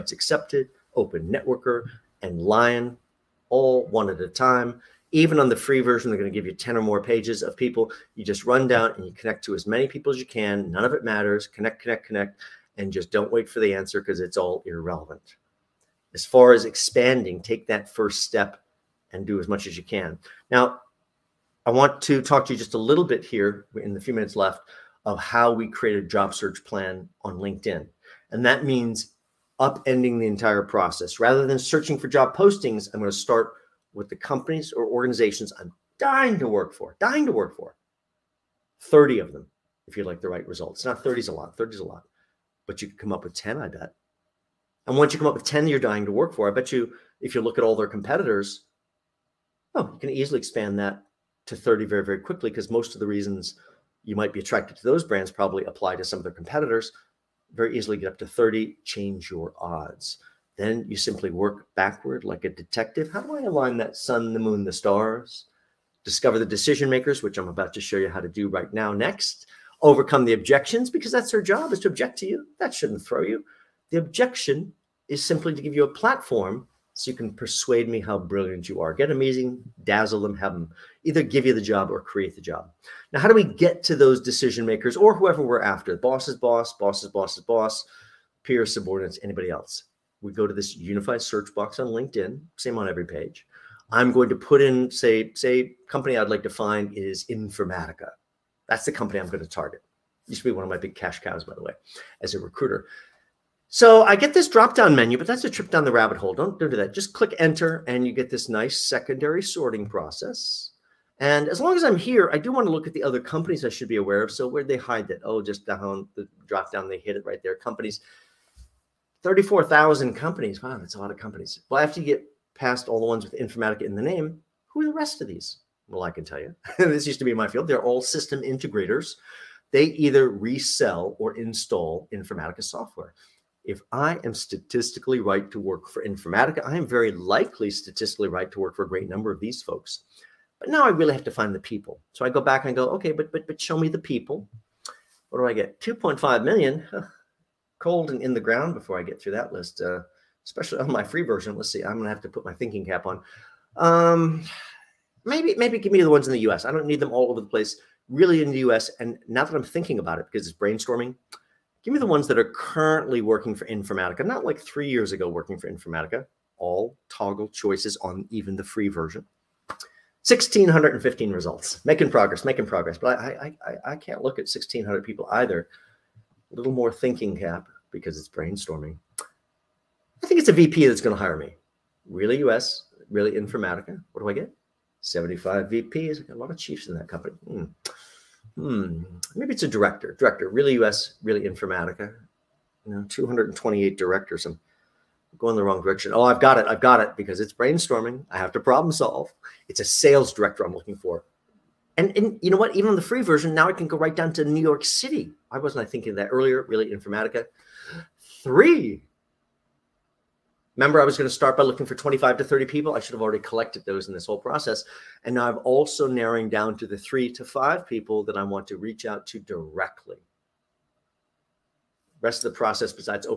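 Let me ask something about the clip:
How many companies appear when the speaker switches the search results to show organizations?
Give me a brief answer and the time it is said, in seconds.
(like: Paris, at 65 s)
34,000, at 119 s.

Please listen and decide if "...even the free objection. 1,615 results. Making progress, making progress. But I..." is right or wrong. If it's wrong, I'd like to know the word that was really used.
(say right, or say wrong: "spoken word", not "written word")
wrong: "version", not "objection".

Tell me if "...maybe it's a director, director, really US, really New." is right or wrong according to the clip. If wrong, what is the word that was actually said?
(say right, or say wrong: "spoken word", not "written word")
wrong: "Informatica", not "New".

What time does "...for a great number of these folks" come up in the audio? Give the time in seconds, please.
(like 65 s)
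138 s.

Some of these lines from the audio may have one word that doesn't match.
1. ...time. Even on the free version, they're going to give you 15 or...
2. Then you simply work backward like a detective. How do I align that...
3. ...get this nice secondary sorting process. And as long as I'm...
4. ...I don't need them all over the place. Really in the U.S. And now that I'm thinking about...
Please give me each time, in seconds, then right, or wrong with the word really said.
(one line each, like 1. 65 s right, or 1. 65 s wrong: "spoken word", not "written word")
1. 4 s wrong: "10", not "15"
2. 60 s right
3. 108 s right
4. 156 s right.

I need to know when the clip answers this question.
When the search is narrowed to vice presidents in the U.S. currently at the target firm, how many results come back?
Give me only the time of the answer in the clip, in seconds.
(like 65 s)
185 s.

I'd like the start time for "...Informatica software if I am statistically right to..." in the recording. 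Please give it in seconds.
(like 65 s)
132 s.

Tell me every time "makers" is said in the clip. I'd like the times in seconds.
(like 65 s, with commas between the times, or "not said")
66 s, 84 s.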